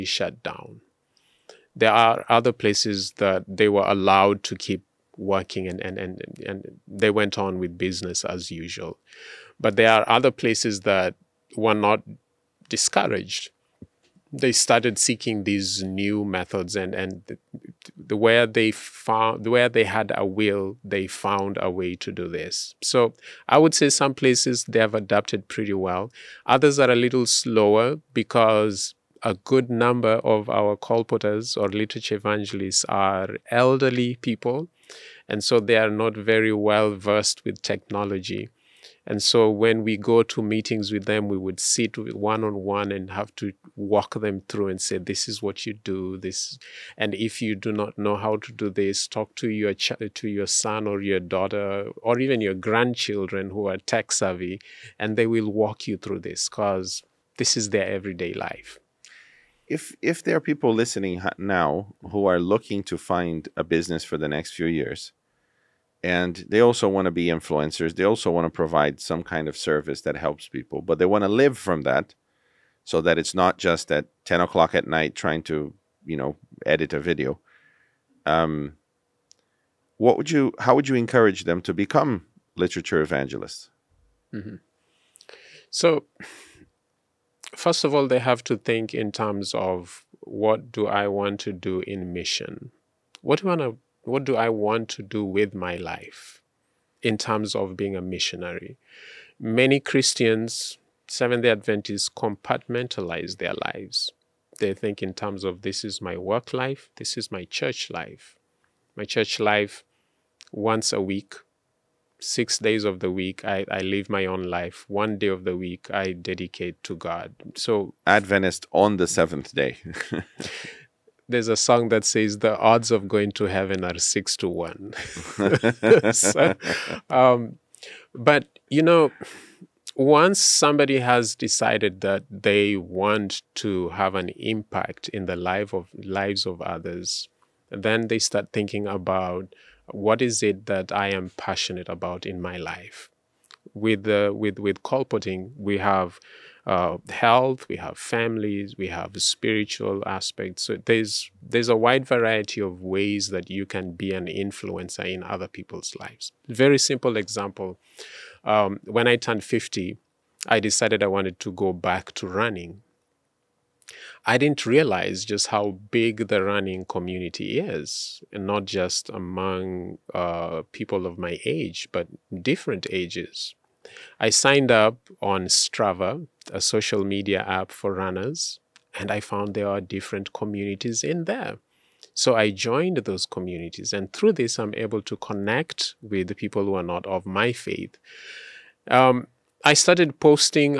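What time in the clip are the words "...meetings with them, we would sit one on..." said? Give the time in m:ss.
0:40.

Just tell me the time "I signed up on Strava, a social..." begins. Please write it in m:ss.
2:54.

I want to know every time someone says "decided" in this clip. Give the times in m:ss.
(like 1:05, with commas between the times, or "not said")
2:11, 2:40.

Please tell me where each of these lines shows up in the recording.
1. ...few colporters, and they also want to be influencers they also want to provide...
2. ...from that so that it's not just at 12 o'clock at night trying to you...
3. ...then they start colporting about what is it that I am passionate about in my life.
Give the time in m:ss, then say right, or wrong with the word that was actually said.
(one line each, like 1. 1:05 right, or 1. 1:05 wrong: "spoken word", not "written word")
1. 1:04 wrong: "years", not "colporters"
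2. 1:11 wrong: "10", not "12"
3. 2:17 wrong: "thinking", not "colporting".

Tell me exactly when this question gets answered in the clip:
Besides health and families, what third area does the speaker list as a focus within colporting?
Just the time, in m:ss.
2:29.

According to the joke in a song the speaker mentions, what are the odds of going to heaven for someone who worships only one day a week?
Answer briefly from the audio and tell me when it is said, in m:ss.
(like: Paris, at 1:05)
6 to 1, at 2:03.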